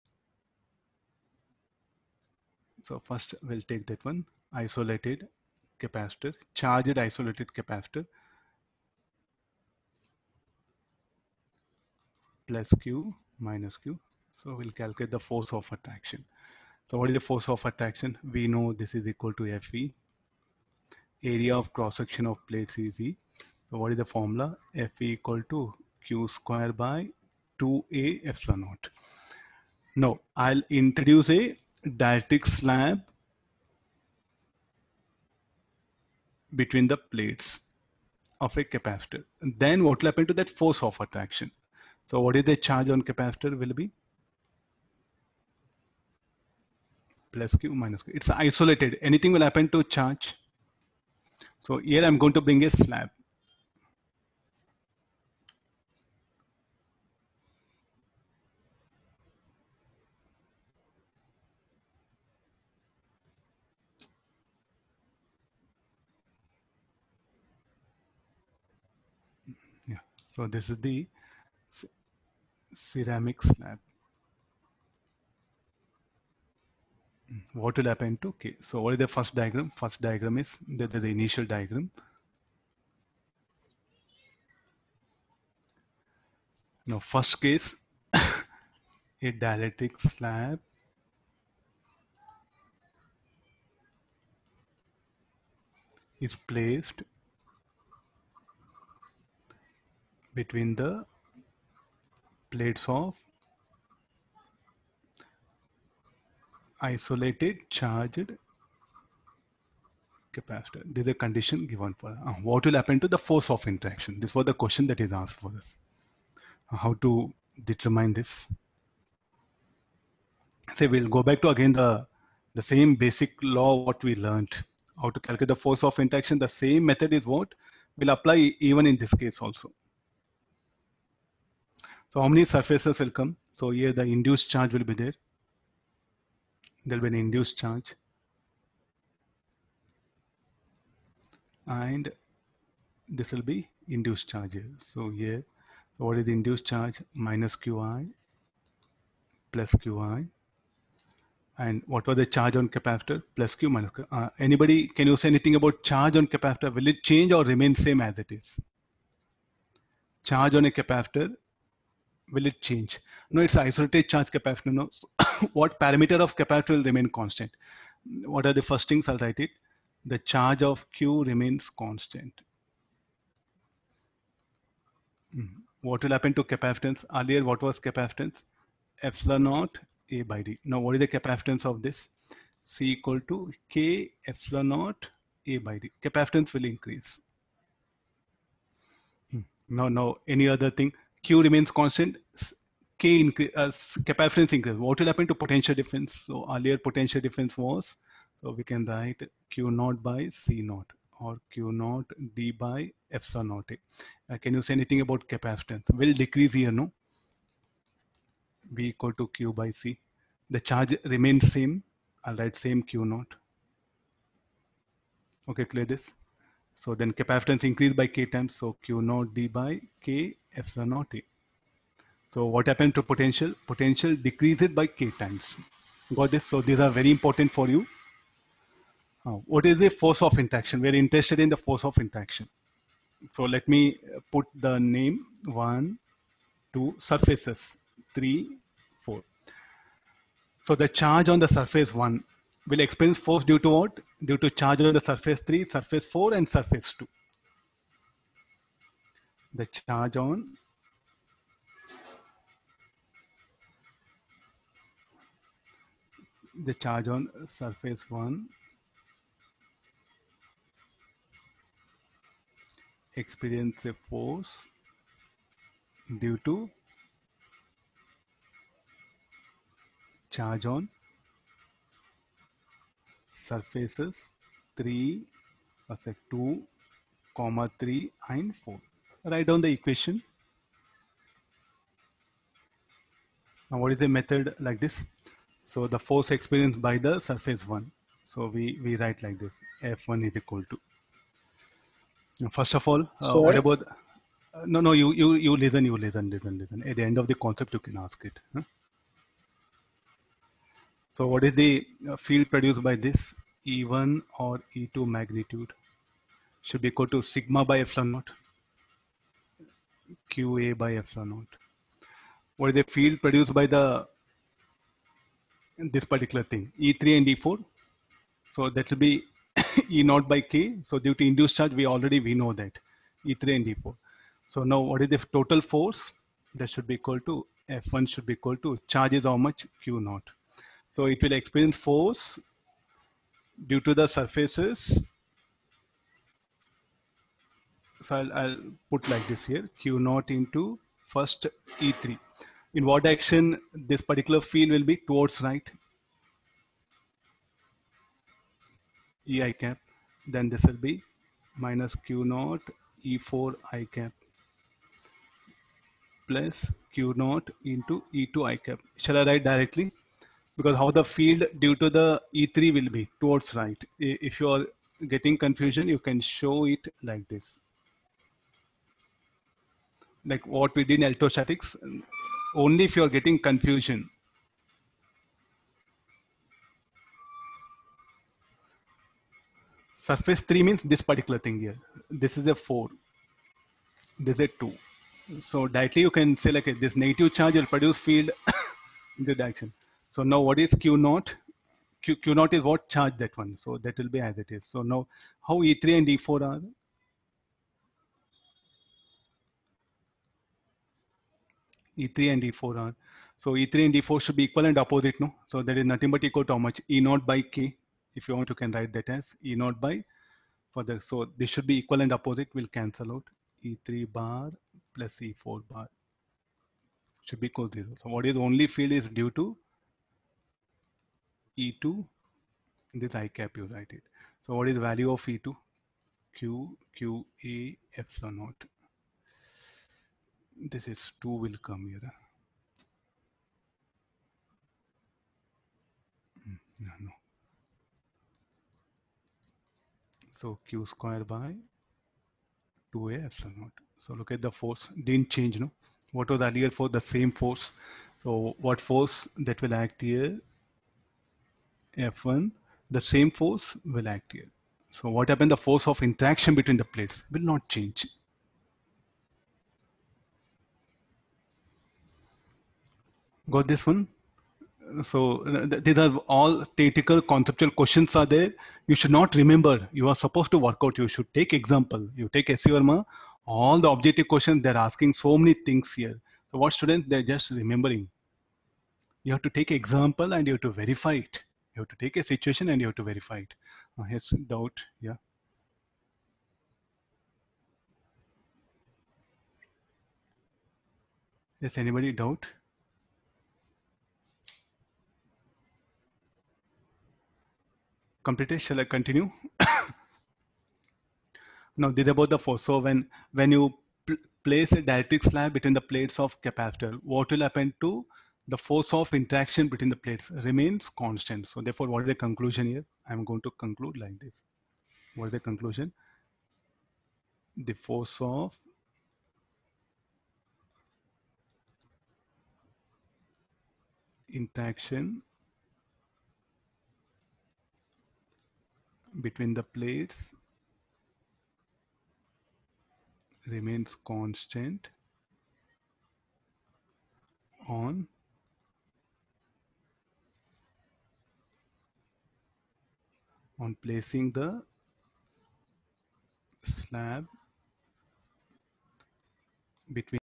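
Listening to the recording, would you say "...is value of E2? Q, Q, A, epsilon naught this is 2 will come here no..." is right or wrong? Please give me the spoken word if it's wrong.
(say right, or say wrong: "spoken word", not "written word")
right.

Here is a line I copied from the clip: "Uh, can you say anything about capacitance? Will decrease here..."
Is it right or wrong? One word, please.
right.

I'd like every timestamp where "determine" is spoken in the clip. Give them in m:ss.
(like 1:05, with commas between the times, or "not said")
1:57.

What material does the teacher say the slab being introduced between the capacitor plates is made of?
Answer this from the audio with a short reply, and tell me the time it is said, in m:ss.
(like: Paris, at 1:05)
ceramic, at 1:12.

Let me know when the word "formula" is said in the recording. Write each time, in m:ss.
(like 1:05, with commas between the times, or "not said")
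0:24.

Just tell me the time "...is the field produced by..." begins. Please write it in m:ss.
5:12.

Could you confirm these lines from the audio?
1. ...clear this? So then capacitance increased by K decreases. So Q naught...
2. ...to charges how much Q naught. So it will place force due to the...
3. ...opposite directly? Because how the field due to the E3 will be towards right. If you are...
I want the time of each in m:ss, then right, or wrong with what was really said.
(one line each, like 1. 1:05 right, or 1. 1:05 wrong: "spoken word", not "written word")
1. 3:35 wrong: "times", not "decreases"
2. 5:28 wrong: "experience", not "place"
3. 5:59 wrong: "write", not "opposite".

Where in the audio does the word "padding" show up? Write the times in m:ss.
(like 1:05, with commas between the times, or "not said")
not said.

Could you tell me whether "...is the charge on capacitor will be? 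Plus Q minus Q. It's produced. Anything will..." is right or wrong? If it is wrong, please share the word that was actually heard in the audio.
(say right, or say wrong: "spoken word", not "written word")
wrong: "isolated", not "produced".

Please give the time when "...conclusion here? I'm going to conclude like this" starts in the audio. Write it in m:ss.
8:32.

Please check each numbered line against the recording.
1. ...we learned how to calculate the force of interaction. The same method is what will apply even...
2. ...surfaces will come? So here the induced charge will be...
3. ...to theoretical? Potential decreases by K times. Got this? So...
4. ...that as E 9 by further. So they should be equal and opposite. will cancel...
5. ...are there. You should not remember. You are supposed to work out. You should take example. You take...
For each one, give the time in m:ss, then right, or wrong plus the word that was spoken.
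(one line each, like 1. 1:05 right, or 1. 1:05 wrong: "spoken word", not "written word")
1. 2:04 right
2. 2:12 right
3. 3:42 wrong: "potential", not "theoretical"
4. 6:48 wrong: "0", not "9"
5. 7:48 right.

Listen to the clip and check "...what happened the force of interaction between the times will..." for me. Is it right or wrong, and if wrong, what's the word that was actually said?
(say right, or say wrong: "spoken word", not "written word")
wrong: "plates", not "times".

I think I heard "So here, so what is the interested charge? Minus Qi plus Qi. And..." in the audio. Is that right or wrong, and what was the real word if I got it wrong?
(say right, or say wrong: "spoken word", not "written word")
wrong: "induced", not "interested".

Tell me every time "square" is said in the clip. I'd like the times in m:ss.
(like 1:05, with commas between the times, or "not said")
0:26, 7:20.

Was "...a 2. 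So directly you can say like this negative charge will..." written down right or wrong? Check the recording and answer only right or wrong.
right.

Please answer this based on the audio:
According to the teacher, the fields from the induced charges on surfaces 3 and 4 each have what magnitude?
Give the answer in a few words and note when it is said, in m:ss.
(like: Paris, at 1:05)
E0/K, at 5:19.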